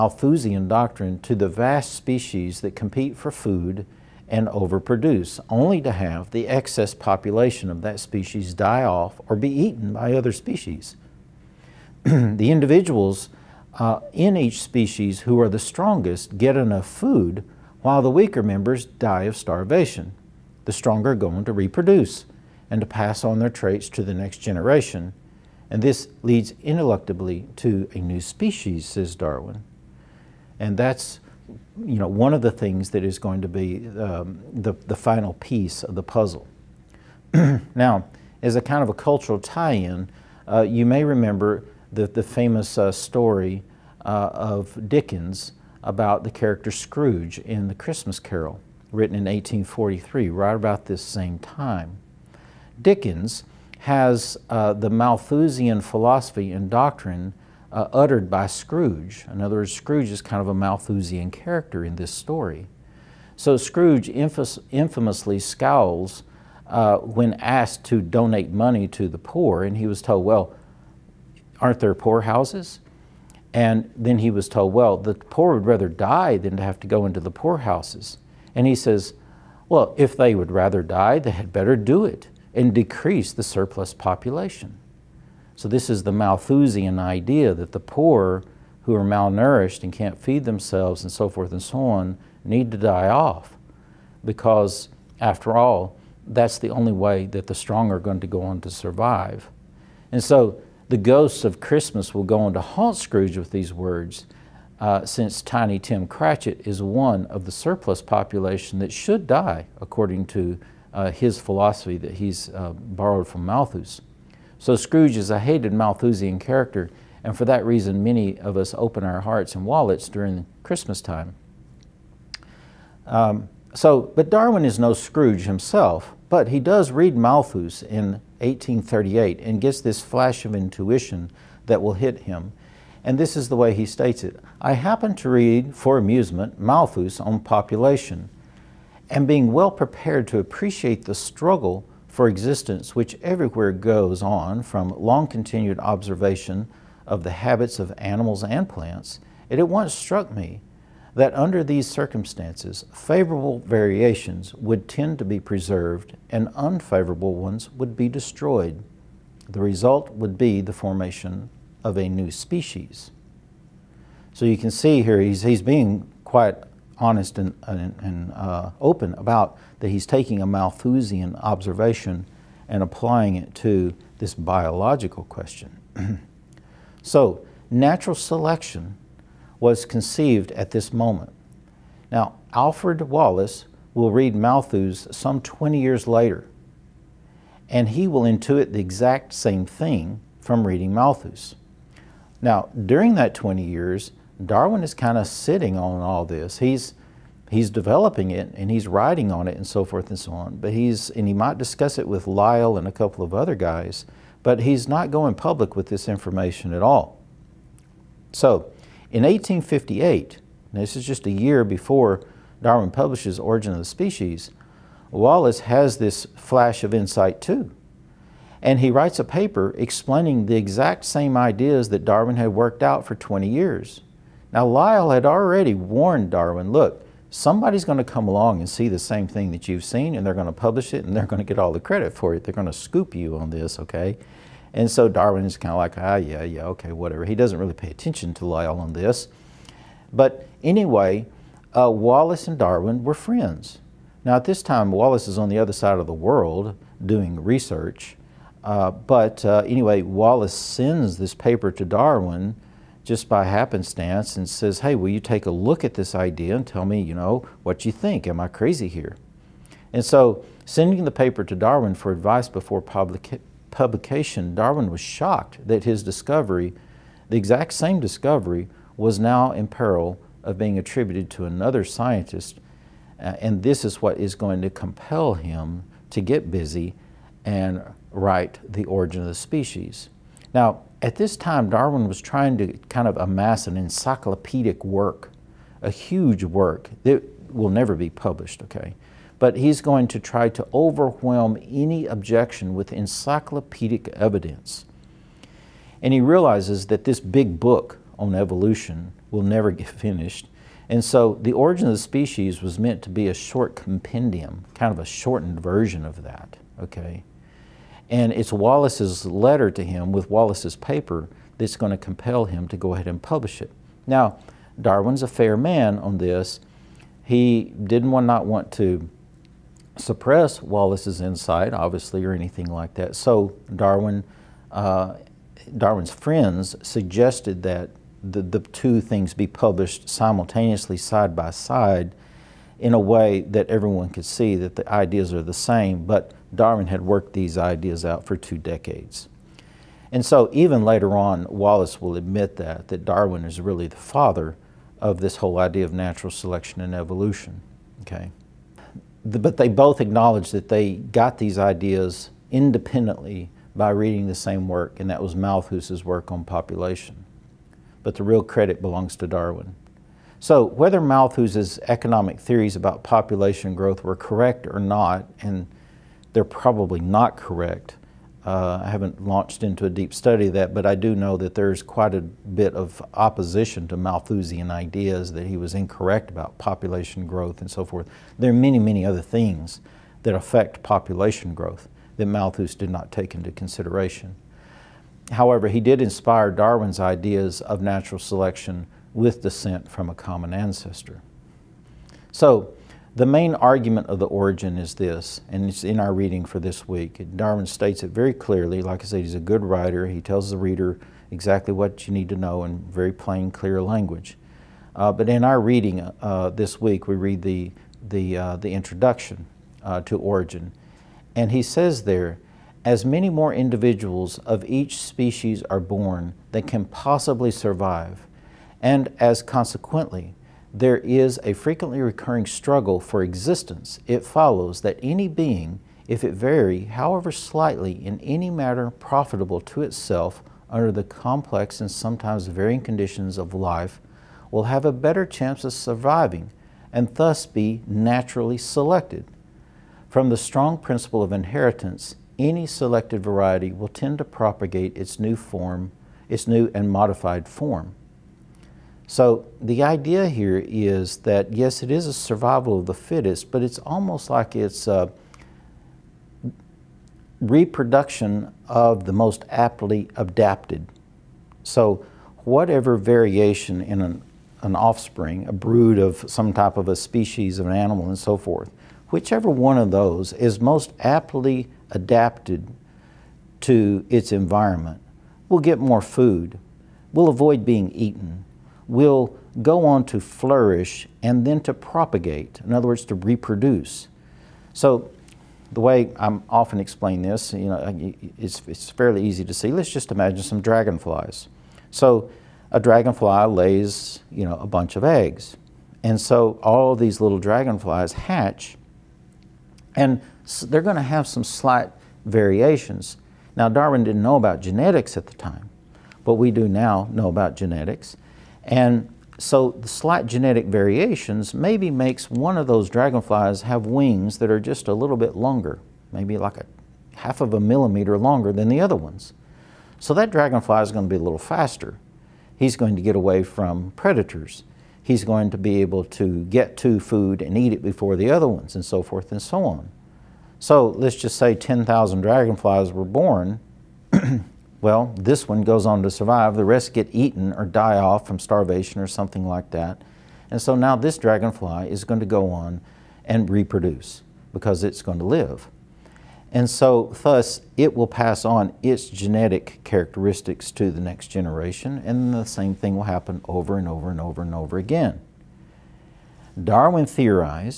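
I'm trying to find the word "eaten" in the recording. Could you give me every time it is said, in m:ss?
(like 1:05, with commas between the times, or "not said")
0:09, 7:57, 8:57.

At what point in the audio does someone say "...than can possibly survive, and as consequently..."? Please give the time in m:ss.
6:56.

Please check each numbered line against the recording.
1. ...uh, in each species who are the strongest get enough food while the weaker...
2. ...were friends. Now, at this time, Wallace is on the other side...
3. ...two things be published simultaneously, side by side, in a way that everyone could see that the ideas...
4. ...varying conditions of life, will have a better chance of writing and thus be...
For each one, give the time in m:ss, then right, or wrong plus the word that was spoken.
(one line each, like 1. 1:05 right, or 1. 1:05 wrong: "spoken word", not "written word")
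1. 0:13 right
2. 4:03 right
3. 5:28 right
4. 7:12 wrong: "surviving", not "writing".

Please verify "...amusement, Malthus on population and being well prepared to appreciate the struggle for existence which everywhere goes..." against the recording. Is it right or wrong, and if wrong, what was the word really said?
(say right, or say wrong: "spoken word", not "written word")
right.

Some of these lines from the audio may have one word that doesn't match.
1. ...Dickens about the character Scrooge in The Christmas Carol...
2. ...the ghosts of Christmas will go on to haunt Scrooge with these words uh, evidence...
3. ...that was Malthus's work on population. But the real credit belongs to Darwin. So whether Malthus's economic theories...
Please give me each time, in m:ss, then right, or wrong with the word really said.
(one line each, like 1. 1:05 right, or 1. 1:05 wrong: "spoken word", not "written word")
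1. 0:44 right
2. 1:40 wrong: "since", not "evidence"
3. 5:55 right.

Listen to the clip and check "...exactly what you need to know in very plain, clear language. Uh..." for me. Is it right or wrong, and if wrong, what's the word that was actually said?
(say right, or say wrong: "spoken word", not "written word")
right.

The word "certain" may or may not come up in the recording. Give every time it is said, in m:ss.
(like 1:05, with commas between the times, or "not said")
not said.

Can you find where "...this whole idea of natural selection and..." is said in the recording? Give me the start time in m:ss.
5:45.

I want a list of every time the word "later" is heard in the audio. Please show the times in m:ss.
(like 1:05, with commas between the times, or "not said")
3:06, 5:40.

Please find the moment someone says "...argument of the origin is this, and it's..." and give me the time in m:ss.
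6:33.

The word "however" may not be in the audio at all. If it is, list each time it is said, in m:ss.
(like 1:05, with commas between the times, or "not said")
6:25, 7:06.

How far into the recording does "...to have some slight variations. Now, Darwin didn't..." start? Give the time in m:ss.
8:20.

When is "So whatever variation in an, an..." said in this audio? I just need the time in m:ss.
7:41.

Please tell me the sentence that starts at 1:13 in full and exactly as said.
And then he was told, well, the poor would rather die than to have to go into the poorhouses.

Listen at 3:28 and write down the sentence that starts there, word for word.
So in 1858, this is just a year before Darwin publishes Origin of the Species, Wallace has this flash of insight too.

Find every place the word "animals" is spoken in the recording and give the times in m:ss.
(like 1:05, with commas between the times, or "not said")
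2:27, 7:47.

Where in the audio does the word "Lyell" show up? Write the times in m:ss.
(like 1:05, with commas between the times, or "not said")
3:22, 3:44, 3:58.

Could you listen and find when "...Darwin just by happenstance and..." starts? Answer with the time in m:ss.
4:11.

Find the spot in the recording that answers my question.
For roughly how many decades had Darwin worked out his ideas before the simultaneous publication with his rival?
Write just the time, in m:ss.
5:38.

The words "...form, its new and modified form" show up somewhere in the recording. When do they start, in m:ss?
7:25.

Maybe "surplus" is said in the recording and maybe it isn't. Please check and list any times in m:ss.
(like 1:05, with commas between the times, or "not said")
1:23, 1:47.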